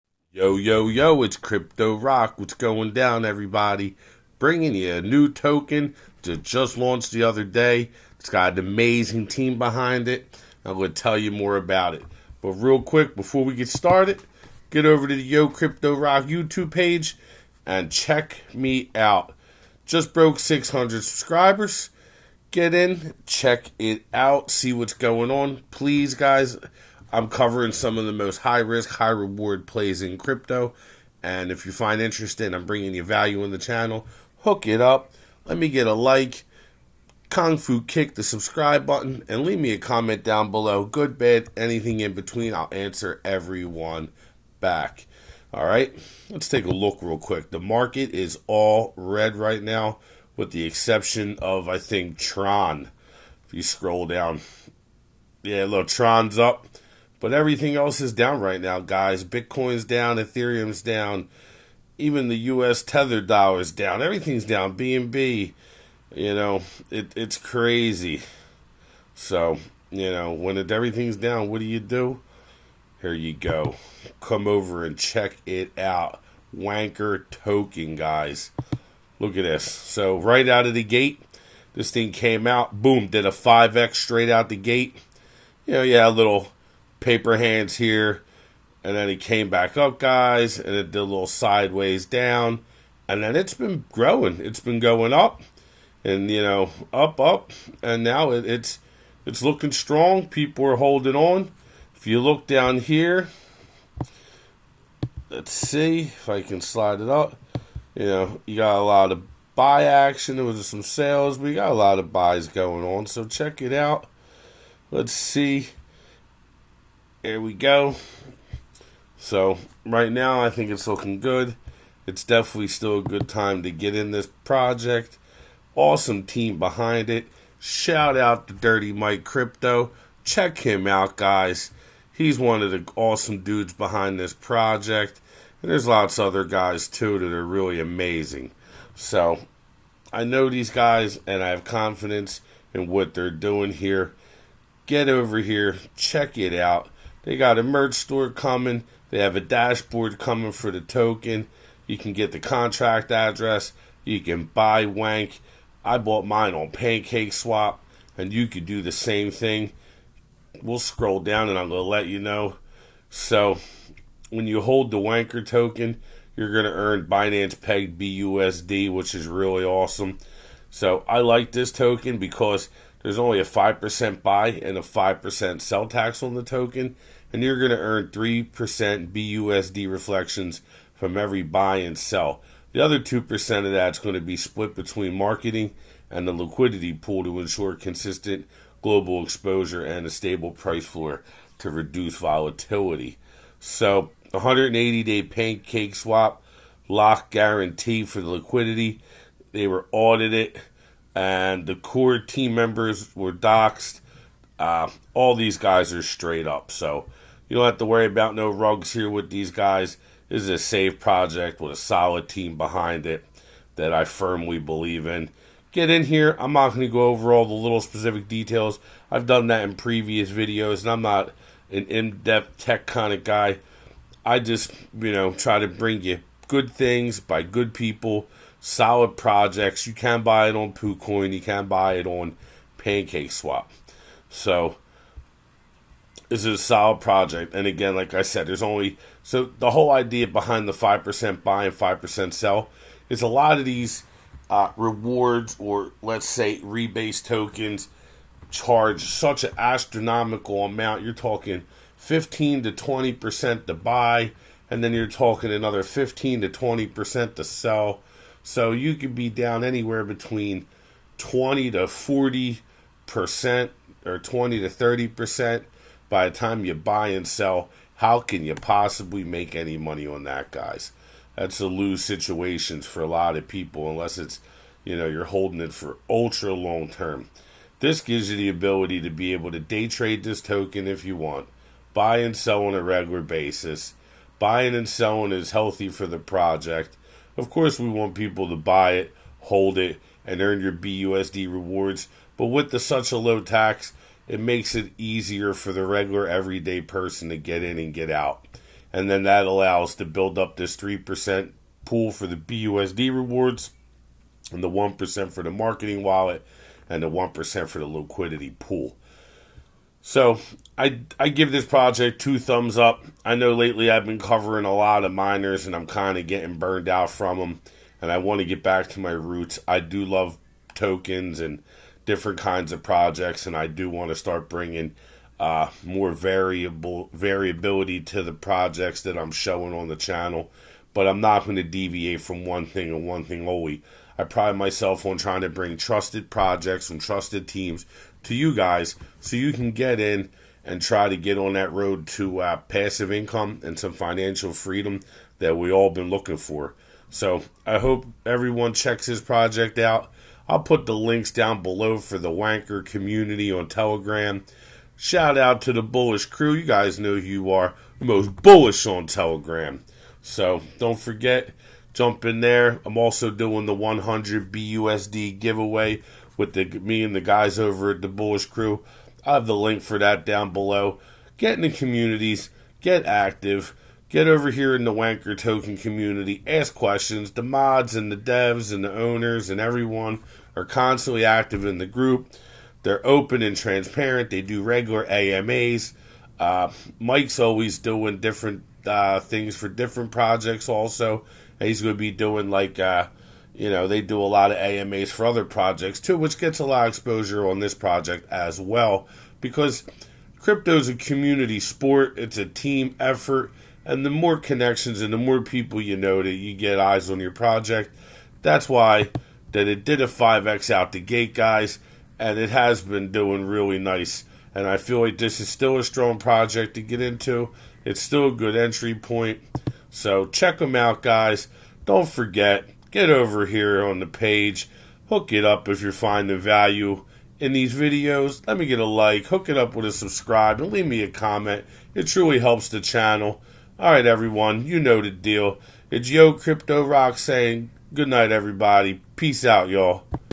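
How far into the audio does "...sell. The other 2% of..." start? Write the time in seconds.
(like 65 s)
181 s.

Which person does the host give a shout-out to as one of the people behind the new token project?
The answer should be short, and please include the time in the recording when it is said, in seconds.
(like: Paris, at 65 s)
Dirty Mike Crypto, at 128 s.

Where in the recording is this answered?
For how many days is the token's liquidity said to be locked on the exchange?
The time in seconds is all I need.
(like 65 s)
194 s.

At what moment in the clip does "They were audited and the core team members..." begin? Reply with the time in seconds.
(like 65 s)
199 s.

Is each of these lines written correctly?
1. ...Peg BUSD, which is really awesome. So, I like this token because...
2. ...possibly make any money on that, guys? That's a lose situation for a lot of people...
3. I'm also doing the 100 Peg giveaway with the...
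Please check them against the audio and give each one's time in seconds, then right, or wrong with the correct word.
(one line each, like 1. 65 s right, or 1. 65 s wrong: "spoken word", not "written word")
1. 167 s right
2. 268 s right
3. 362 s wrong: "BUSD", not "Peg".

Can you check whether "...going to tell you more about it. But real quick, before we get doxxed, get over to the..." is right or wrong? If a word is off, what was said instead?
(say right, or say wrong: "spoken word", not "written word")
wrong: "started", not "doxxed".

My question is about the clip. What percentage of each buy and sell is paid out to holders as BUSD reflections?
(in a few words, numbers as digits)
3%.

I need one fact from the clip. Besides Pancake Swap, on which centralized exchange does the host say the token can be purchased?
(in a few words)
KuCoin.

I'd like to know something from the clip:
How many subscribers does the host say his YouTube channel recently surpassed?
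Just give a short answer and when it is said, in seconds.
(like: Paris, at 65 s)
600, at 20 s.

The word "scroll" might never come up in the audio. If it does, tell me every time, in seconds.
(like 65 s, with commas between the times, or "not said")
53 s, 160 s.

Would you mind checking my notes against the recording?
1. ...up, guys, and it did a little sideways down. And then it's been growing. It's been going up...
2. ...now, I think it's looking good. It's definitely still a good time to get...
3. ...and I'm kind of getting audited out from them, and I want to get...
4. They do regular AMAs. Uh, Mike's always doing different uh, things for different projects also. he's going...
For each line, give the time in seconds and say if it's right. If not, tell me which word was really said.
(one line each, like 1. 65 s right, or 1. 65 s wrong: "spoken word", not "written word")
1. 89 s right
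2. 120 s right
3. 315 s wrong: "burned", not "audited"
4. 384 s right.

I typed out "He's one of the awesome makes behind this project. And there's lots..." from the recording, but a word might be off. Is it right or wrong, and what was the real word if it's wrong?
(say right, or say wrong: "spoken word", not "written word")
wrong: "dudes", not "makes".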